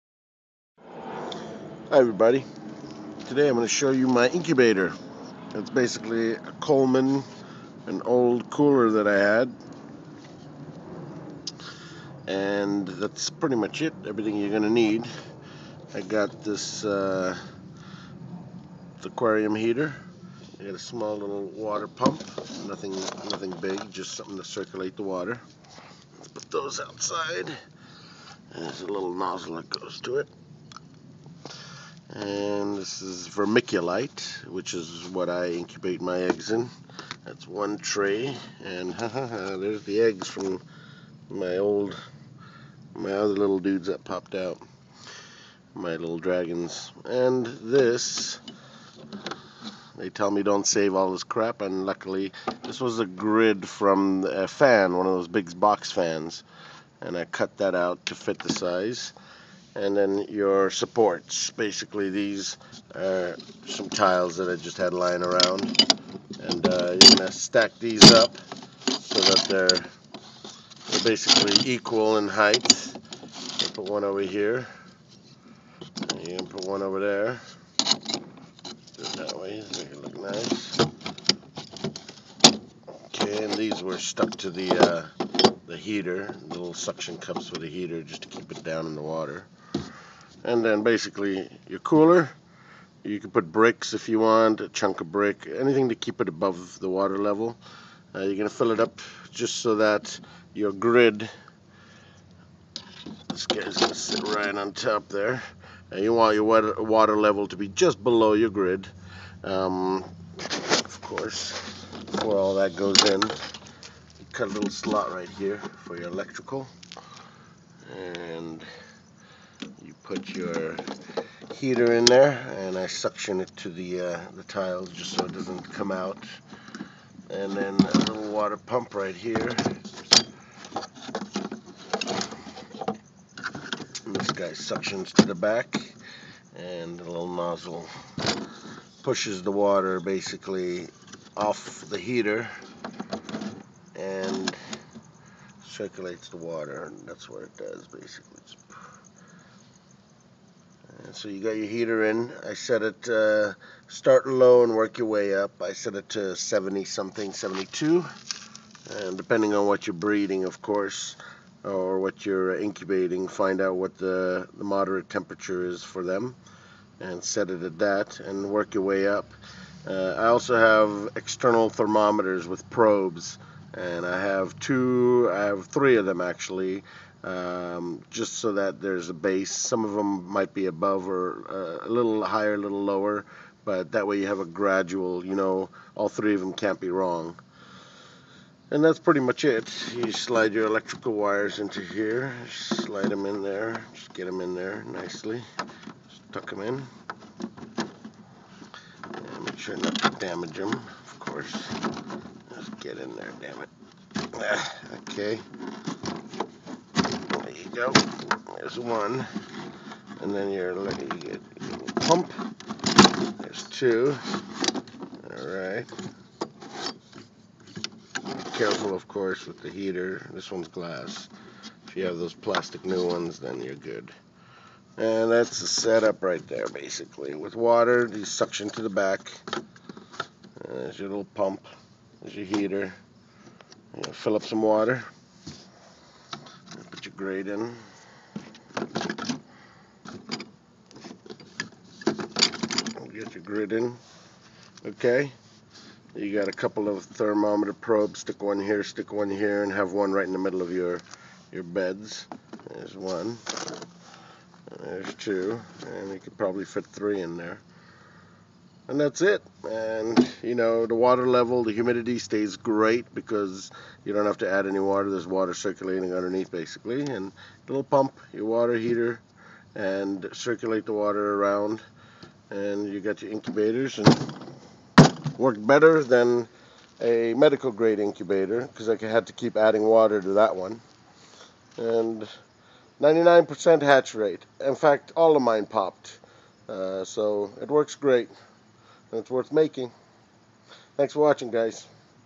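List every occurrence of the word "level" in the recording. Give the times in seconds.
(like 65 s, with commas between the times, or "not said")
97 s, 107 s, 261 s.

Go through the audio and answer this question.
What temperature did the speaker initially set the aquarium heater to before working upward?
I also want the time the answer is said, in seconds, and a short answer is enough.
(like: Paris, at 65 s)
72, at 157 s.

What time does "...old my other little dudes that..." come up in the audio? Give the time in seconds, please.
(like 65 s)
41 s.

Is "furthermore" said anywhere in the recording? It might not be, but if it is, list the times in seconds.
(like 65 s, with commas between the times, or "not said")
not said.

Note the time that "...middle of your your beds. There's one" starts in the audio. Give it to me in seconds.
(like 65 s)
250 s.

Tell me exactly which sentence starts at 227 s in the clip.
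With water, you suction to the back.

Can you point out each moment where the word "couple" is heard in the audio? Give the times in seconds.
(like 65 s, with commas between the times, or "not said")
246 s.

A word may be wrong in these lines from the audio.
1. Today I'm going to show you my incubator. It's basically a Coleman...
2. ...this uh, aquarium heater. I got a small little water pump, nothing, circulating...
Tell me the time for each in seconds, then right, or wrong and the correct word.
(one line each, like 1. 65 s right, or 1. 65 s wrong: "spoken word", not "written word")
1. 3 s right
2. 16 s wrong: "nothing", not "circulating".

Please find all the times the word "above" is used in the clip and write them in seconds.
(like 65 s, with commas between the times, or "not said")
96 s, 180 s.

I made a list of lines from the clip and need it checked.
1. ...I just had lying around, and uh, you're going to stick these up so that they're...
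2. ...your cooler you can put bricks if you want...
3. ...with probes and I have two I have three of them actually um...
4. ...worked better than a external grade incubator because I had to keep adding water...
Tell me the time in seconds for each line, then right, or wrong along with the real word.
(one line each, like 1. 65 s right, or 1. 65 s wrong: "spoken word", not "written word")
1. 64 s wrong: "stack", not "stick"
2. 91 s right
3. 172 s right
4. 275 s wrong: "medical", not "external".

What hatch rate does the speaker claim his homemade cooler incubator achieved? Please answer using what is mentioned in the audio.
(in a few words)
99%.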